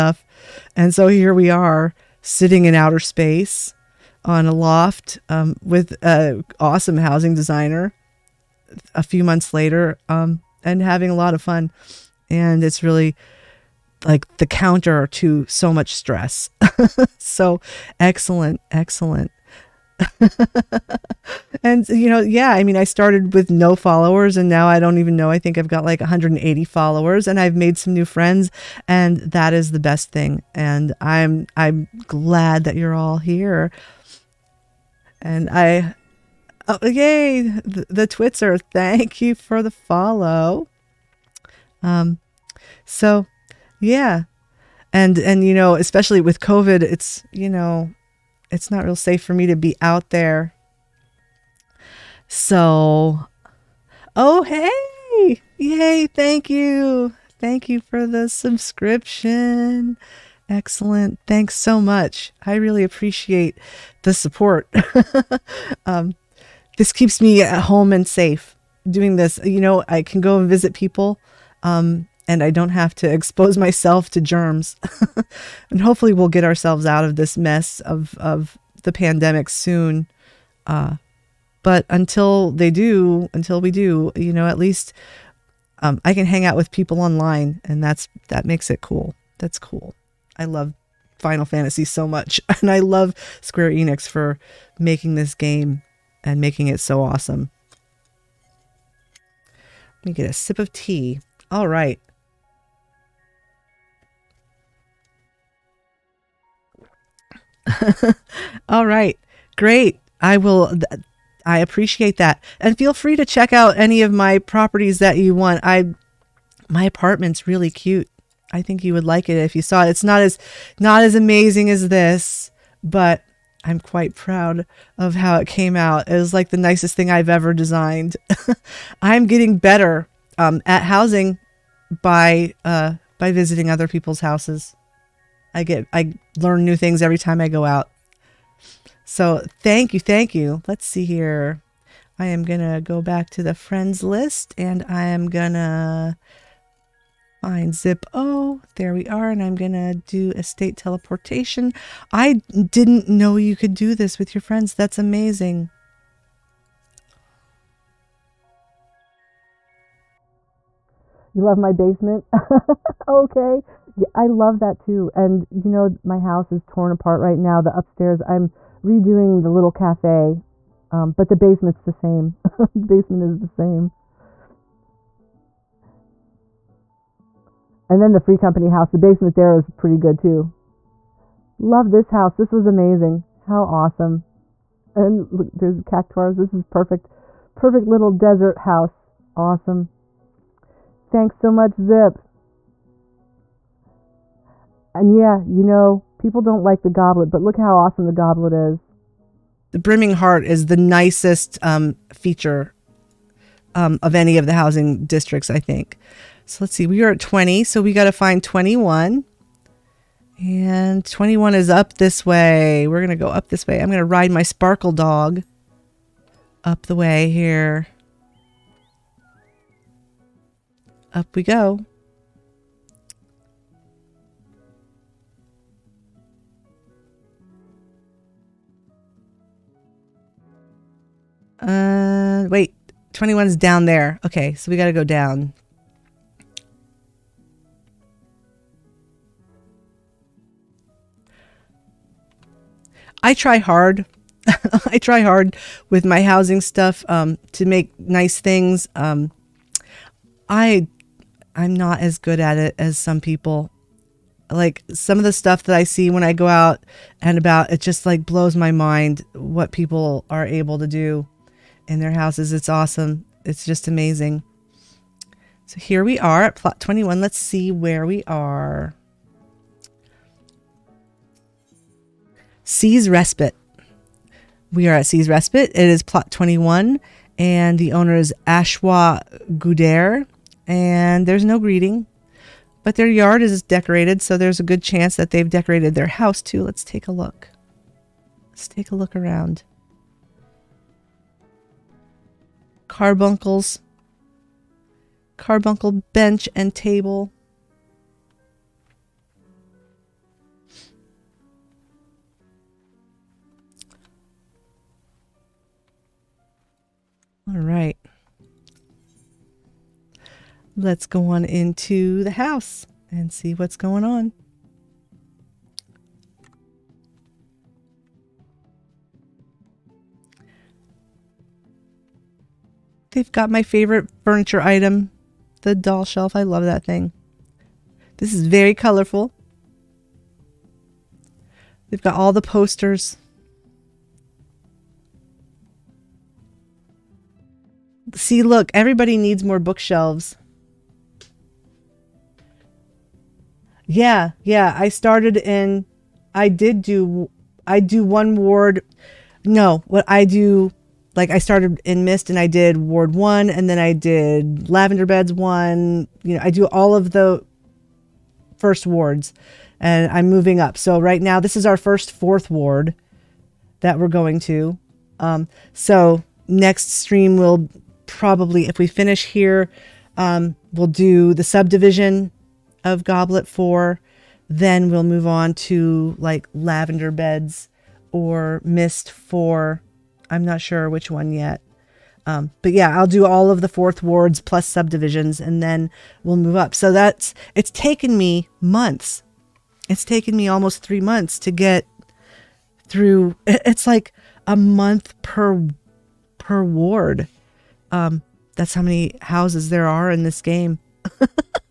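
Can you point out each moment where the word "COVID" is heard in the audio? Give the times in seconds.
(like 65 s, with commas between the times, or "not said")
46 s.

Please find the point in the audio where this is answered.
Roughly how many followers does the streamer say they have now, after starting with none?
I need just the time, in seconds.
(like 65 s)
26 s.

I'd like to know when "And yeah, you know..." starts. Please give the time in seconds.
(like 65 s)
194 s.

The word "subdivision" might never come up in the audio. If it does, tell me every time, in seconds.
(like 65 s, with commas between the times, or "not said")
371 s, 384 s.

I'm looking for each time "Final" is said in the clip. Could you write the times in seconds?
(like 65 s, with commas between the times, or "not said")
91 s.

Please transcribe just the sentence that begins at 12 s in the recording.
And it's really like the counter to so much stress.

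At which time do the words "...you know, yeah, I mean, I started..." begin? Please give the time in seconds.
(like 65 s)
21 s.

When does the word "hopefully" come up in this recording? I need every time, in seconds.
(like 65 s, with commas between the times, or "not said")
75 s.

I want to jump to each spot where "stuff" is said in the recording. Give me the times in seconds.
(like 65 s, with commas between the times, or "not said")
246 s, 255 s.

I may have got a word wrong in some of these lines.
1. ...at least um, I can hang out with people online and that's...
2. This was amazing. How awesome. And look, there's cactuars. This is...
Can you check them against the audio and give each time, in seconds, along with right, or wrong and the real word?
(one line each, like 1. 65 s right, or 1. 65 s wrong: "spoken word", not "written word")
1. 84 s right
2. 182 s right.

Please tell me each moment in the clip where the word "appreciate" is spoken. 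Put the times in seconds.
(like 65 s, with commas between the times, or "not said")
62 s, 111 s.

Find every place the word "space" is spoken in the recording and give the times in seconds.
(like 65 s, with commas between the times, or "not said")
2 s.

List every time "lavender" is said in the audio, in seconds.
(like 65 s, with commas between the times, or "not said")
354 s, 376 s.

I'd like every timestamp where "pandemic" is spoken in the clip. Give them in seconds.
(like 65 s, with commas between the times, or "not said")
78 s.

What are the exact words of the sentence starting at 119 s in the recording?
It's not as not as amazing as this, but I'm quite proud of how it came out.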